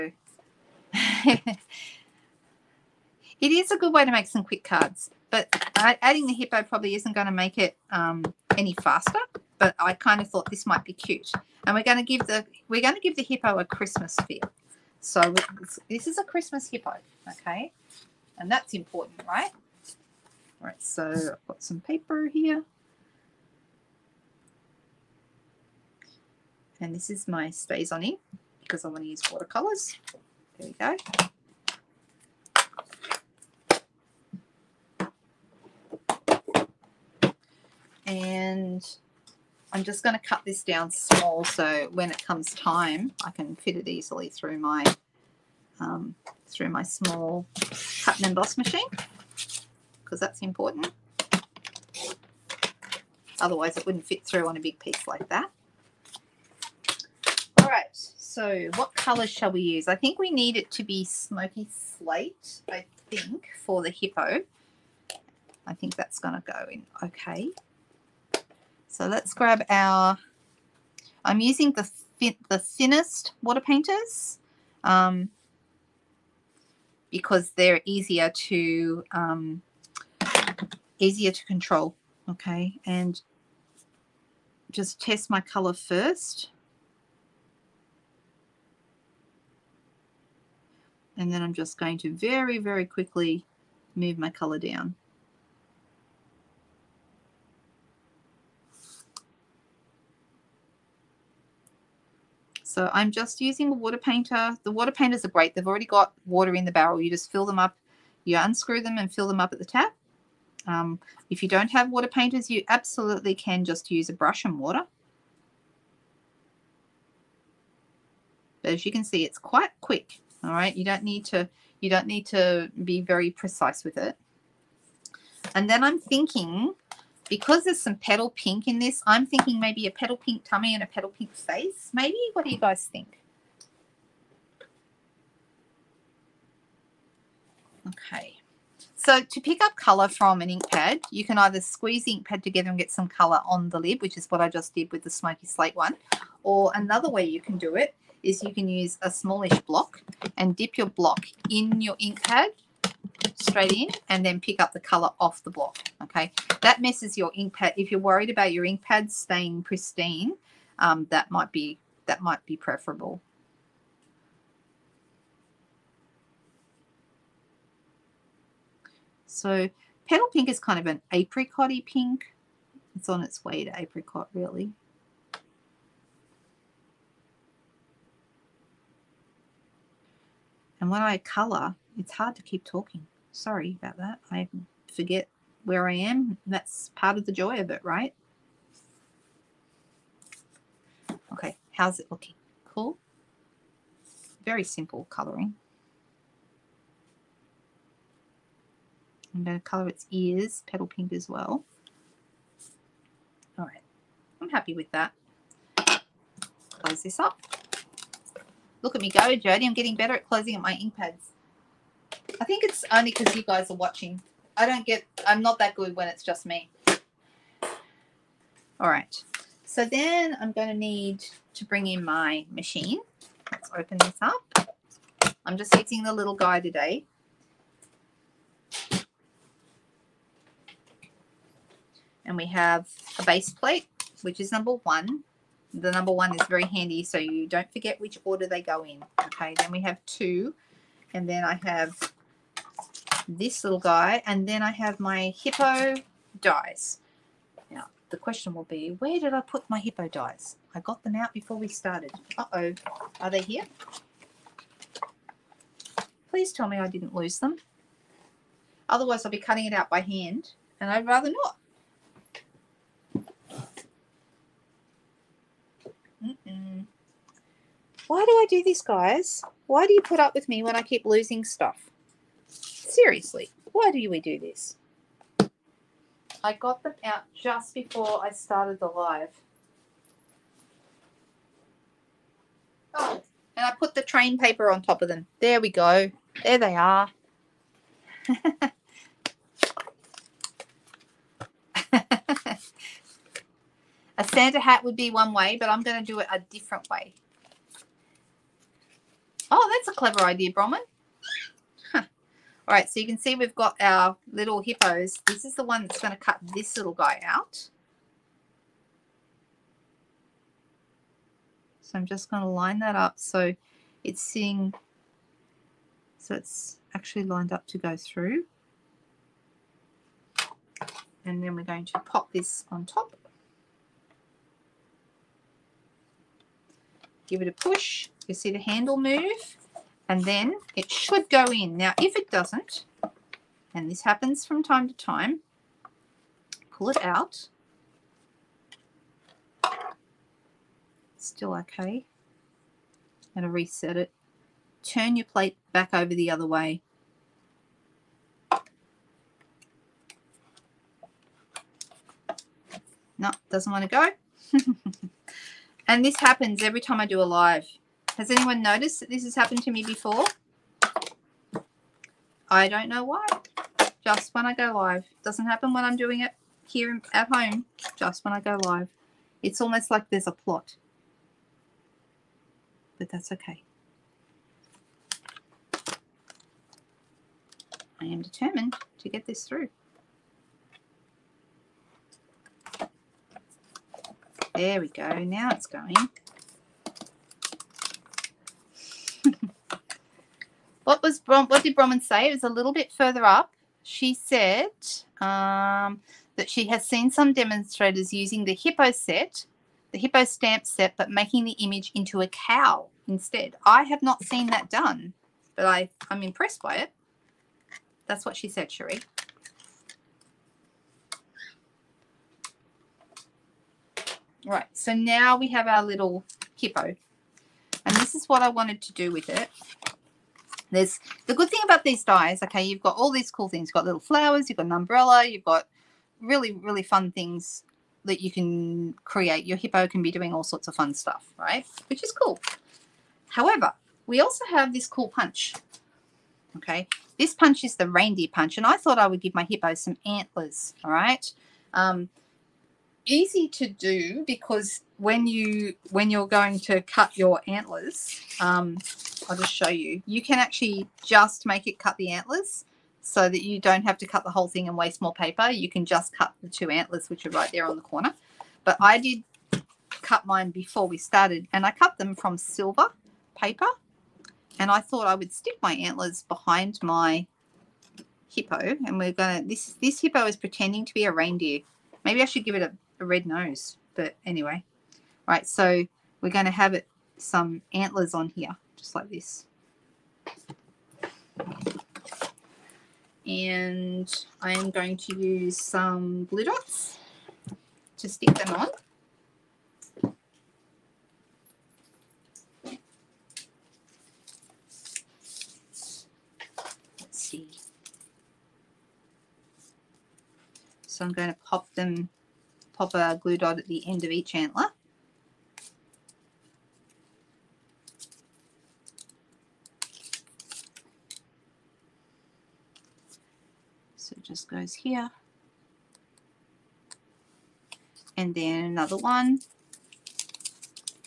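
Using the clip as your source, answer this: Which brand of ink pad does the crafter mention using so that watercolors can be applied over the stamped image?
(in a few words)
StazOn.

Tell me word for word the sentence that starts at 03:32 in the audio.
I think it's only because you guys are watching.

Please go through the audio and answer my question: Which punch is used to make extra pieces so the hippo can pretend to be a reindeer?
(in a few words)
Reindeer punch.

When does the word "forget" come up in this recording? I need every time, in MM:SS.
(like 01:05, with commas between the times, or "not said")
03:04, 03:57.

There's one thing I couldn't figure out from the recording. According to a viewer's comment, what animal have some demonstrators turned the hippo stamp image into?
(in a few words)
Cow.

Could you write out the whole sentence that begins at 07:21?
Um, easy to do because when you when you're going to cut your antlers, um, I'll just show you.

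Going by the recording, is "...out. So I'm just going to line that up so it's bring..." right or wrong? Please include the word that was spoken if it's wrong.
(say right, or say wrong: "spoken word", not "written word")
wrong: "seeing", not "bring".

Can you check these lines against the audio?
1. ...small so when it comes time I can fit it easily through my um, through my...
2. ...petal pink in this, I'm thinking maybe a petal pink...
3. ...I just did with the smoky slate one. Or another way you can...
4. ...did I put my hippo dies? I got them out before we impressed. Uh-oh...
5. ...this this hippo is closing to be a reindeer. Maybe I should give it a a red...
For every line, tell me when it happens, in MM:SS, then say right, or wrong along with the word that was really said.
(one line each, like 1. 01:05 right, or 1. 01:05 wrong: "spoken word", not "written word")
1. 00:40 right
2. 02:07 right
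3. 02:24 right
4. 04:09 wrong: "started", not "impressed"
5. 07:49 wrong: "pretending", not "closing".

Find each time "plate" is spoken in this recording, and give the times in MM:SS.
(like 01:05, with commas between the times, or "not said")
03:53, 05:45.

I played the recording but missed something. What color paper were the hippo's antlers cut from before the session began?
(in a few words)
Silver.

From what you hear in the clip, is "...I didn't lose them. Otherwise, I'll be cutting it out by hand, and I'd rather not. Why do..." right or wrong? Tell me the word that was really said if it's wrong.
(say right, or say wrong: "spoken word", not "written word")
right.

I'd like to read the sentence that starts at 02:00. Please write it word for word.
All right, you don't need to you don't need to be very precise with it.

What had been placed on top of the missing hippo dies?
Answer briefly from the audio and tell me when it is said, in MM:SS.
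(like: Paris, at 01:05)
Train paper, at 04:44.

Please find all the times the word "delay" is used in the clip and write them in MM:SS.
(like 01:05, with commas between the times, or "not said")
not said.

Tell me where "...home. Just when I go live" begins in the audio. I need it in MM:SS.
06:07.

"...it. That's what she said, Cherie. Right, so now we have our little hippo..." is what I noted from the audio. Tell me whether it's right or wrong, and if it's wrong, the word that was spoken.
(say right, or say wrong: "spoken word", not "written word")
right.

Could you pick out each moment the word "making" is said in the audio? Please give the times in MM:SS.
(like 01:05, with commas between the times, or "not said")
06:41.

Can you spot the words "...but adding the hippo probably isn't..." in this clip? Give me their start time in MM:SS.
00:05.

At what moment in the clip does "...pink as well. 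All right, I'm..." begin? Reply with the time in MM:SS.
03:20.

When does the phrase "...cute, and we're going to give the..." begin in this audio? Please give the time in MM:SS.
00:10.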